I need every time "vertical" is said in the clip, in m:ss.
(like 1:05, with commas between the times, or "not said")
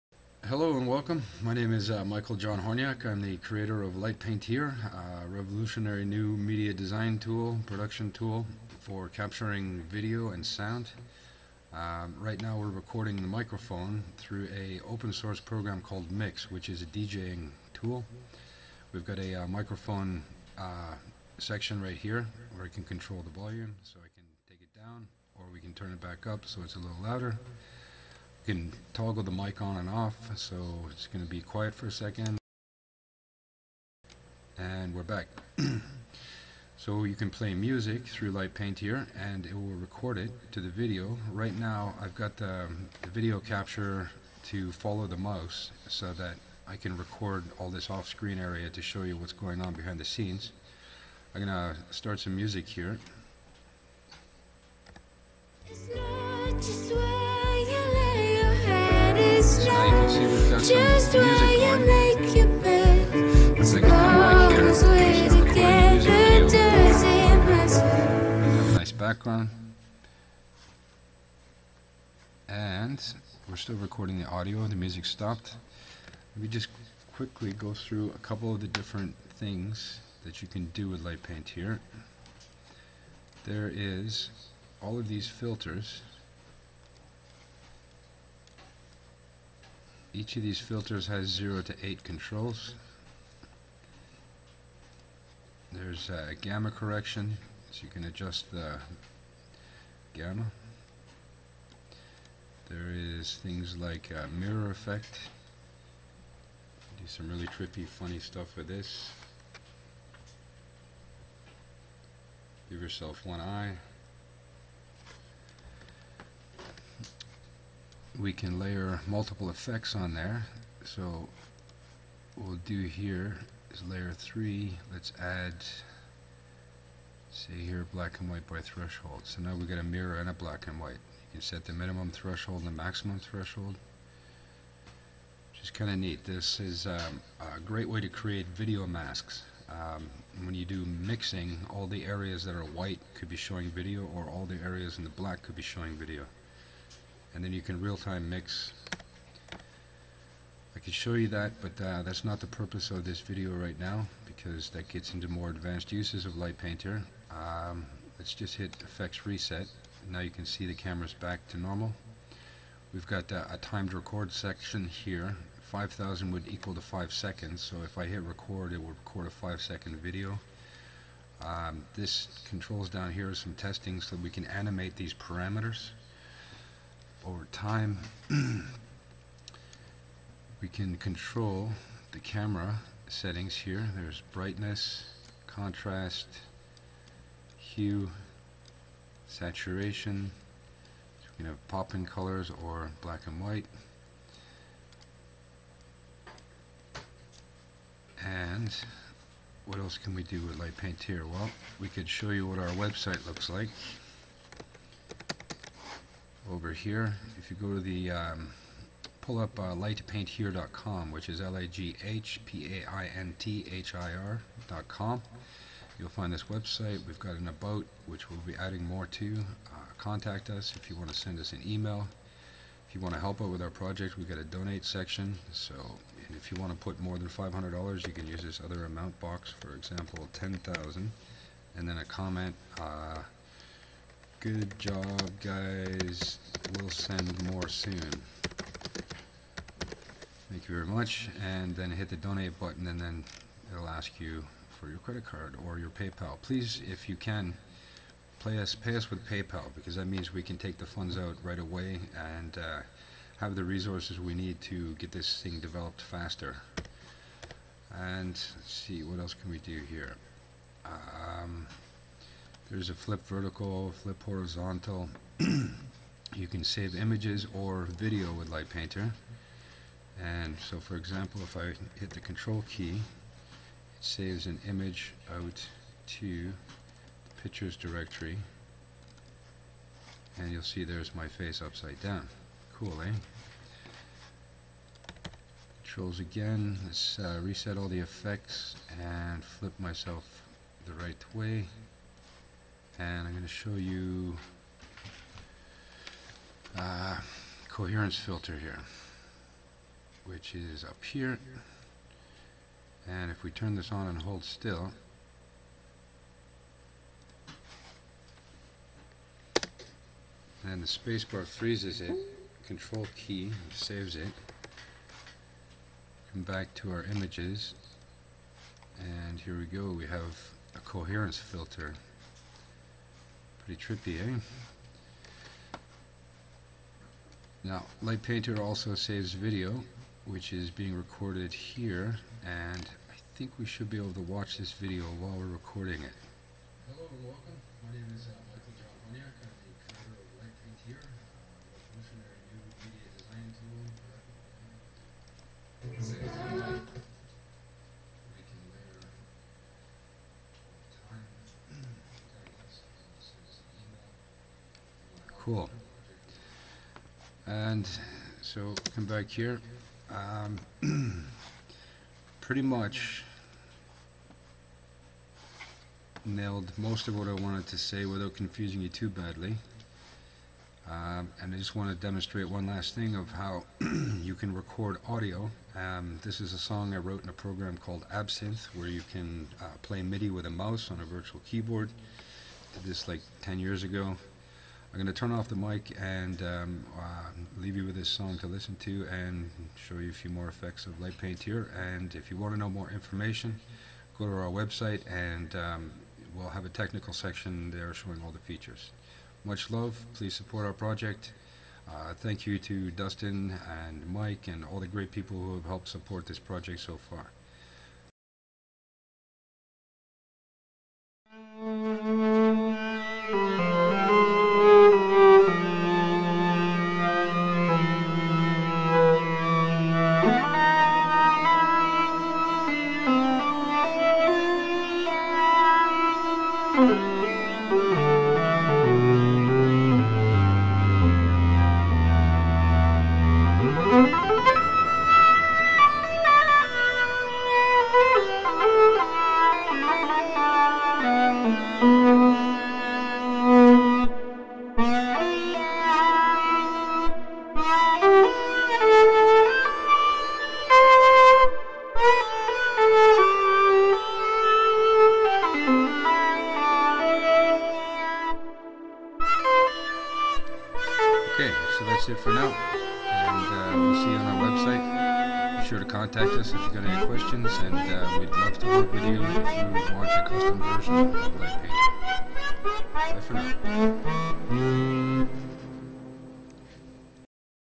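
4:23.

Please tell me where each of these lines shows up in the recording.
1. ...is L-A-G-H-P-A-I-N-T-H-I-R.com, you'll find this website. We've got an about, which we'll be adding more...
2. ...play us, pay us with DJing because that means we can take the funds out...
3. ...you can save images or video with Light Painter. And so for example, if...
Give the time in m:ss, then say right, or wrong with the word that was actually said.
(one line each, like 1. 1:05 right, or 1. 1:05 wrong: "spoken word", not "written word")
1. 3:31 right
2. 4:08 wrong: "PayPal", not "DJing"
3. 4:25 right.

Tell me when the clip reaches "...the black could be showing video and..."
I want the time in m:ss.
2:25.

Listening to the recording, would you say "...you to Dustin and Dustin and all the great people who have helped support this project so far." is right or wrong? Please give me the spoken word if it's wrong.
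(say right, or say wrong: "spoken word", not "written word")
wrong: "Mike", not "Dustin".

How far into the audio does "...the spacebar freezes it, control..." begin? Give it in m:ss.
5:10.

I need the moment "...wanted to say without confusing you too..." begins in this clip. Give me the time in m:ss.
6:07.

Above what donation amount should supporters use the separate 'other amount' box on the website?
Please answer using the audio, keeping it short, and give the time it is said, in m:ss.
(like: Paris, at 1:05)
$500, at 3:47.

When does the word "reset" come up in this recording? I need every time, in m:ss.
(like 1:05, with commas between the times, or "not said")
2:39, 4:47.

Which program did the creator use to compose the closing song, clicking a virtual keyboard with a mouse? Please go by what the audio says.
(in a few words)
Absinthe.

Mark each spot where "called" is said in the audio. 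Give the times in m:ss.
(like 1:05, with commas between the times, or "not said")
0:15, 6:17.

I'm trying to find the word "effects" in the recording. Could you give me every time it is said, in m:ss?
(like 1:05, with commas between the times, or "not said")
1:44, 1:59, 2:38, 4:47, 6:30.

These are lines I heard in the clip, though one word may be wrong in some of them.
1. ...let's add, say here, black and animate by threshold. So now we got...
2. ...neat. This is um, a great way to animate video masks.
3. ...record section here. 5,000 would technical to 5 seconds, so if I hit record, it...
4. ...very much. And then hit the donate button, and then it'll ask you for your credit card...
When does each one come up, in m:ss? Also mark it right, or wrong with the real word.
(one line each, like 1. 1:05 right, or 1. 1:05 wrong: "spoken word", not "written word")
1. 2:04 wrong: "white", not "animate"
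2. 2:15 wrong: "create", not "animate"
3. 2:43 wrong: "equal", not "technical"
4. 4:00 right.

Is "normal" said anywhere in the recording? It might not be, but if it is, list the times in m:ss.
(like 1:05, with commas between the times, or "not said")
2:41.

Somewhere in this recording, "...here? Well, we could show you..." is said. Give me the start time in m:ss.
3:21.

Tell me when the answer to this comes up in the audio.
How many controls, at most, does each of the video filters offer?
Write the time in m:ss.
1:31.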